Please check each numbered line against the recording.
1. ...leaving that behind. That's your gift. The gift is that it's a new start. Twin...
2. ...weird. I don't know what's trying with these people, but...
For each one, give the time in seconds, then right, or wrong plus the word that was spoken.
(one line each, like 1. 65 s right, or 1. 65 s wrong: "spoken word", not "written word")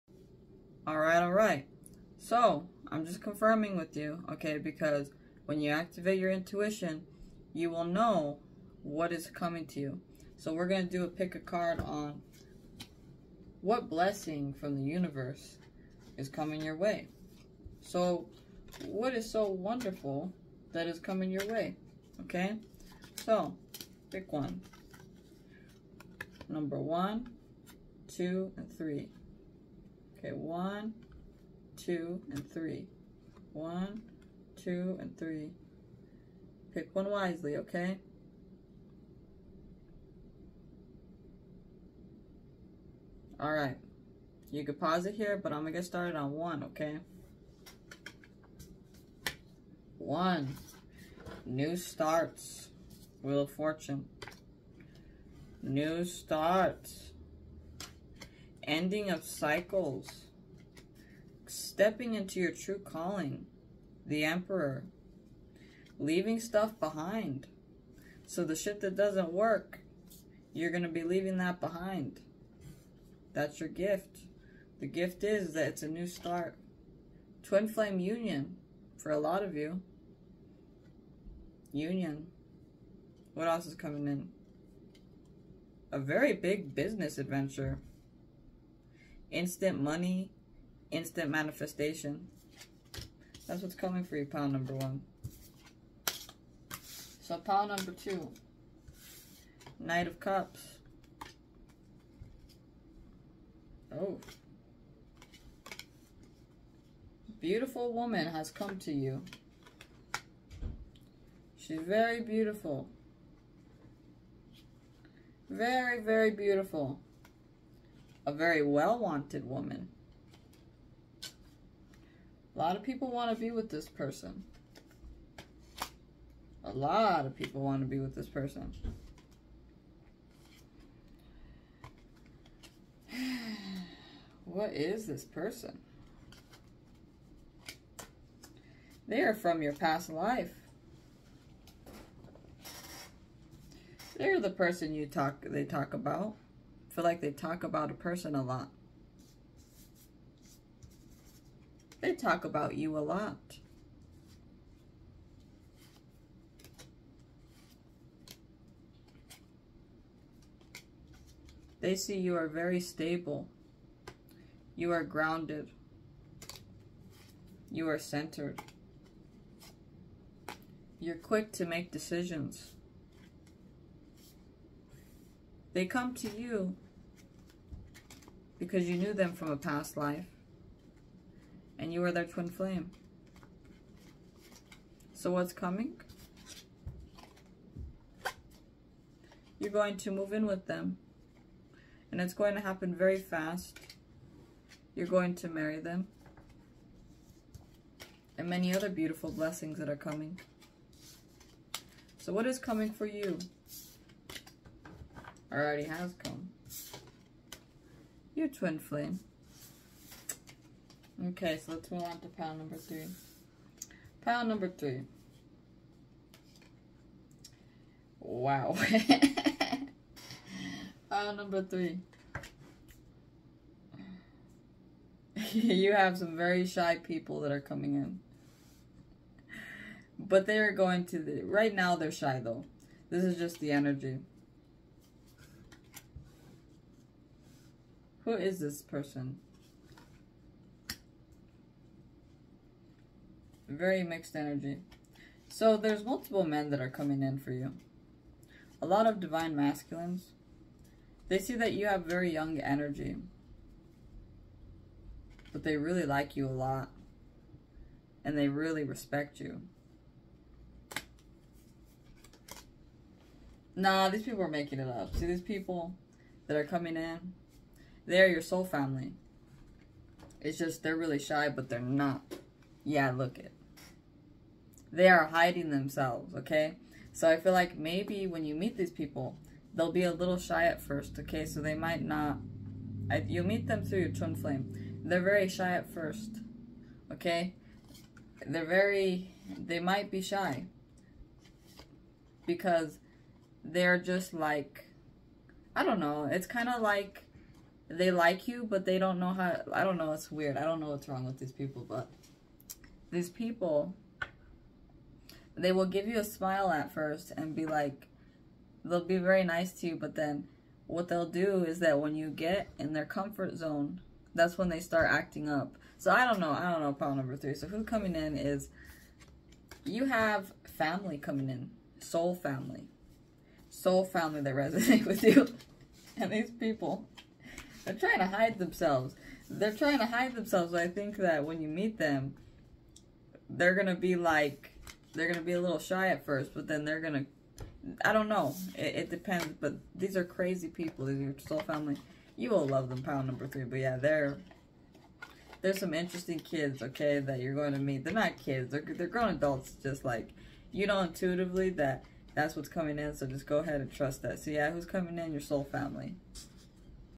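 1. 71 s right
2. 300 s wrong: "wrong", not "trying".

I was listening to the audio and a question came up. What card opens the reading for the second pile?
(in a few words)
Knight of Cups.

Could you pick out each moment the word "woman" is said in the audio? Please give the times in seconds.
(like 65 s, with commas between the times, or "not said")
107 s, 119 s.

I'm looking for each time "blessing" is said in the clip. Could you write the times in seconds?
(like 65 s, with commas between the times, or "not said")
13 s, 199 s.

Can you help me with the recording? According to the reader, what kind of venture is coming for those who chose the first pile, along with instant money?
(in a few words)
Big business adventure.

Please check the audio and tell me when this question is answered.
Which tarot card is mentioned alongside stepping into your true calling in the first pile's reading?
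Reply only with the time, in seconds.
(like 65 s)
64 s.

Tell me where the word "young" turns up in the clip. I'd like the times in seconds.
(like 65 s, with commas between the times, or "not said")
252 s.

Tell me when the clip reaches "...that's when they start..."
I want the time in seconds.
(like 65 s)
314 s.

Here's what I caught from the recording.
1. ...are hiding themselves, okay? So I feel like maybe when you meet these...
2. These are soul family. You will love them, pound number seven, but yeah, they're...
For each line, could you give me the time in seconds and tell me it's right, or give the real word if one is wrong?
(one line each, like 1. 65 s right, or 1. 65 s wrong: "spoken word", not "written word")
1. 275 s right
2. 341 s wrong: "three", not "seven".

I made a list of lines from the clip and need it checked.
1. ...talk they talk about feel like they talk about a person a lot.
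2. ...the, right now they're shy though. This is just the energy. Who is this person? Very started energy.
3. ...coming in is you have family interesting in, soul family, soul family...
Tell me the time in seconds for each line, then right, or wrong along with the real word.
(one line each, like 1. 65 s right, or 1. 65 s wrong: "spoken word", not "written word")
1. 145 s right
2. 231 s wrong: "mixed", not "started"
3. 317 s wrong: "coming", not "interesting".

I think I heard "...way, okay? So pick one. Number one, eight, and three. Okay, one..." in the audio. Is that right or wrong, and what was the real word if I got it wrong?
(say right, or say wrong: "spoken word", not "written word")
wrong: "two", not "eight".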